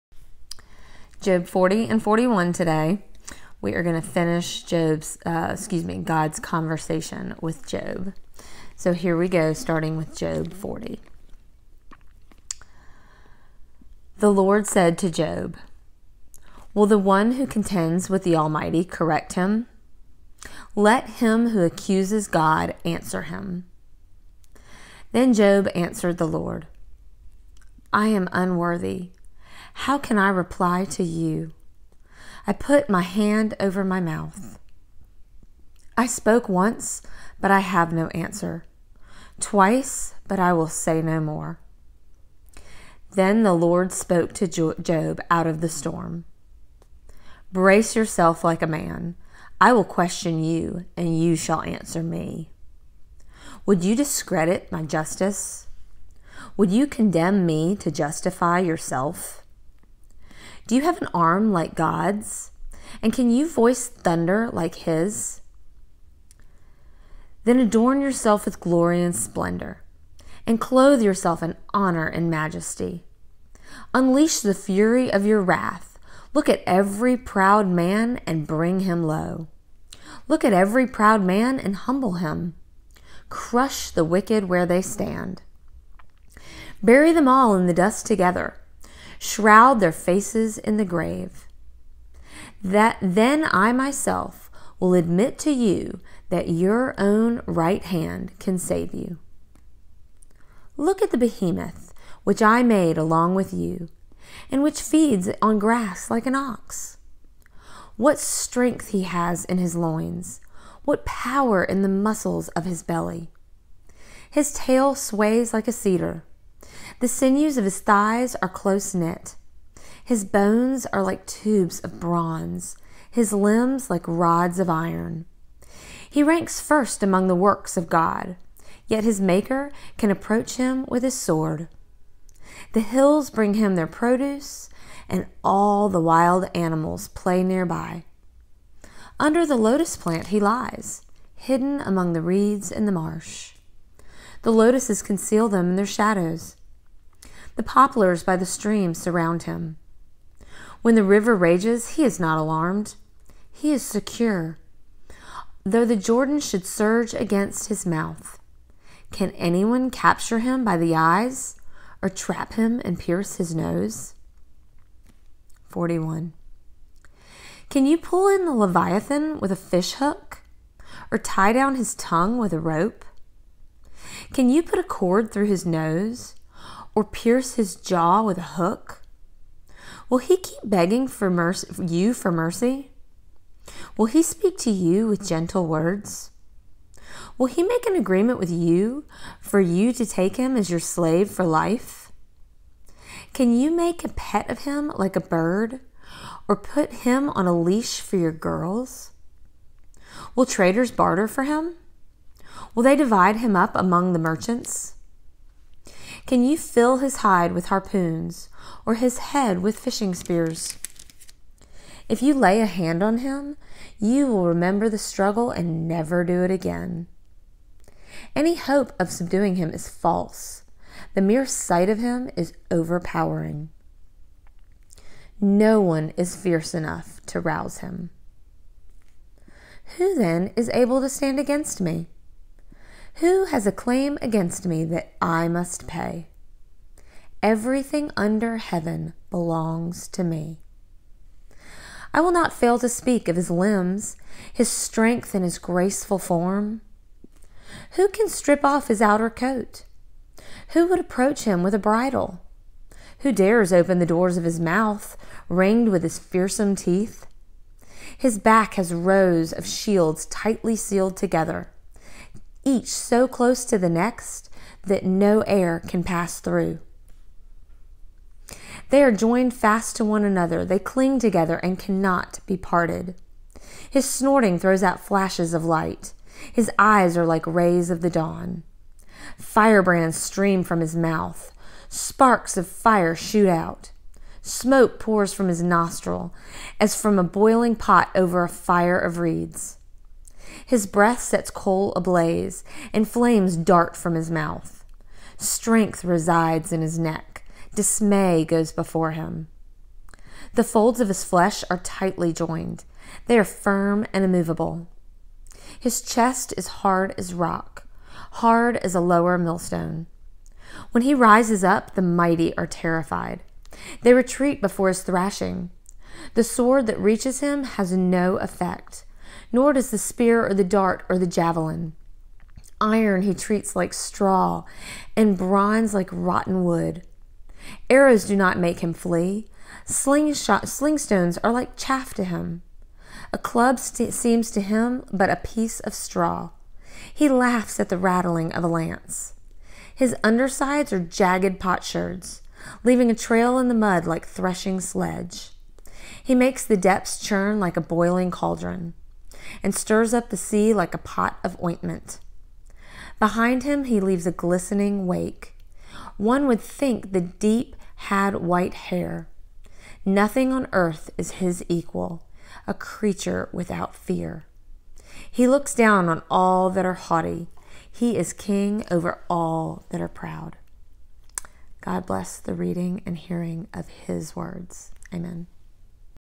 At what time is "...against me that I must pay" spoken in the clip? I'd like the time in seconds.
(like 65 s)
234 s.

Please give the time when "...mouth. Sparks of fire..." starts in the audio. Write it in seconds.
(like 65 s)
280 s.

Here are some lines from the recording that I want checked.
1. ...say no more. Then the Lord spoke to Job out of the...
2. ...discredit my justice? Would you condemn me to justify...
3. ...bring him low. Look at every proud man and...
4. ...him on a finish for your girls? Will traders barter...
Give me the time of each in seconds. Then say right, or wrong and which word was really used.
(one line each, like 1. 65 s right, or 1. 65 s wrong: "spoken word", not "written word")
1. 40 s right
2. 53 s right
3. 78 s right
4. 197 s wrong: "leash", not "finish".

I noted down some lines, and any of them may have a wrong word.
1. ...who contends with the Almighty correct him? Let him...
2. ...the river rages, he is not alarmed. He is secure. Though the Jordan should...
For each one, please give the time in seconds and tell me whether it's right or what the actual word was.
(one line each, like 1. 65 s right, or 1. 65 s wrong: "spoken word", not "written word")
1. 17 s right
2. 150 s right.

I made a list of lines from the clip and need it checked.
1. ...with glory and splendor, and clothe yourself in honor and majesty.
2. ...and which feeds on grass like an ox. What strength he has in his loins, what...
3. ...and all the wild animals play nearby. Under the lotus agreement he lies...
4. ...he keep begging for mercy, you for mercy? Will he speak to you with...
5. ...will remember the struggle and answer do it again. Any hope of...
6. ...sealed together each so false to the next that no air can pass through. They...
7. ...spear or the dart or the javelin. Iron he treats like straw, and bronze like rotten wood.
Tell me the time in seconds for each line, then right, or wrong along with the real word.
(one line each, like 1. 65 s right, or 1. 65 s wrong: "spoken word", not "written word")
1. 68 s right
2. 104 s right
3. 135 s wrong: "plant", not "agreement"
4. 180 s right
5. 214 s wrong: "never", not "answer"
6. 260 s wrong: "close", not "false"
7. 319 s right.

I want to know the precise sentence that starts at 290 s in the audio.
His breath sets coal ablaze, and flames dart from his mouth.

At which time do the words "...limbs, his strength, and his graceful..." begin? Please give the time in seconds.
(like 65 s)
243 s.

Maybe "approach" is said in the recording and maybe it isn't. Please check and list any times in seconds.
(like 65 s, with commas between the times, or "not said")
130 s, 250 s.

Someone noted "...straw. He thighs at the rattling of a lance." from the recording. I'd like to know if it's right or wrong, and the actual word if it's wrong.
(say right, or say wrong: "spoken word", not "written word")
wrong: "laughs", not "thighs".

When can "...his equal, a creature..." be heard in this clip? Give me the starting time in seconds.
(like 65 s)
361 s.